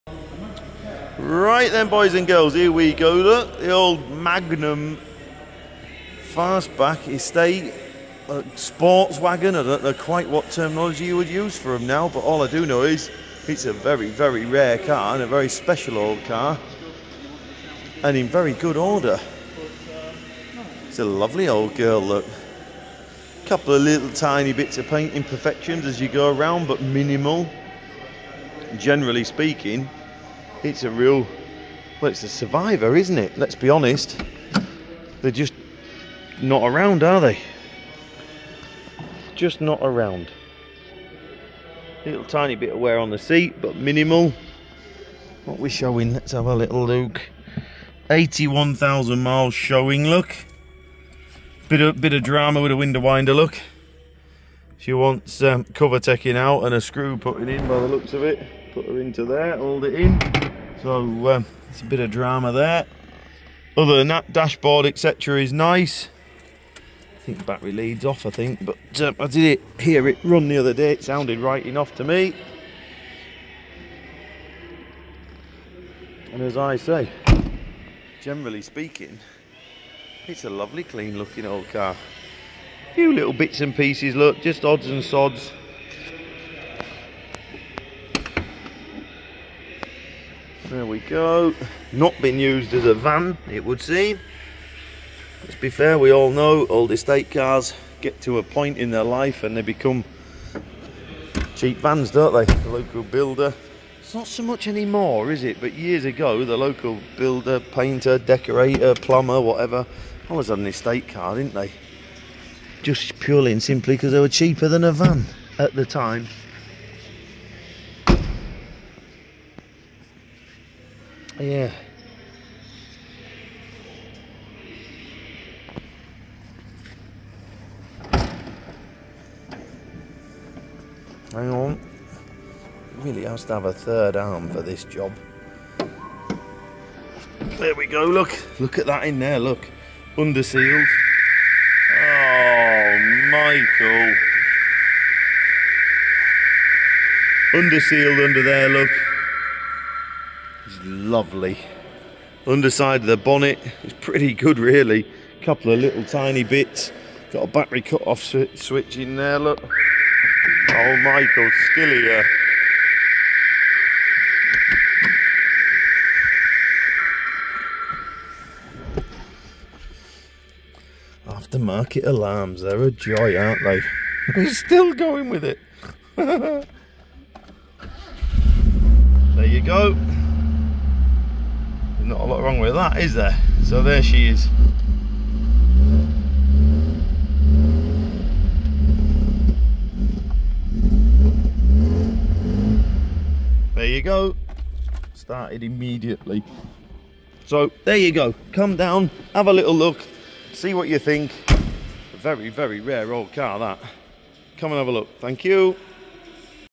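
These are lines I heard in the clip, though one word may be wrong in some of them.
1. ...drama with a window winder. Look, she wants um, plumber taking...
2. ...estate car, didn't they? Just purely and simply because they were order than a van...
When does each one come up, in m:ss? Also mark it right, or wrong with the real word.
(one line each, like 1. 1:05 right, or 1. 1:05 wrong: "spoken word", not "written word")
1. 0:52 wrong: "cover", not "plumber"
2. 1:50 wrong: "cheaper", not "order".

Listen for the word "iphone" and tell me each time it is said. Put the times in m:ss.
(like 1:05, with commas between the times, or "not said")
not said.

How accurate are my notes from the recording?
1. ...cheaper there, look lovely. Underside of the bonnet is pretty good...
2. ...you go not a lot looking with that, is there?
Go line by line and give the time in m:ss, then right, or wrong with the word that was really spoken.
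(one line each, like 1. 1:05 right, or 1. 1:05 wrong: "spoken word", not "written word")
1. 2:28 wrong: "under", not "cheaper"
2. 2:59 wrong: "wrong", not "looking".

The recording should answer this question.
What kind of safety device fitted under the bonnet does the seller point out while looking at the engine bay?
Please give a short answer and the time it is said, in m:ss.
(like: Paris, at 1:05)
battery cut-off switch, at 2:37.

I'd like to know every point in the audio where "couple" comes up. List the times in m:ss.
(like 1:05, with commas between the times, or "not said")
0:23, 2:35.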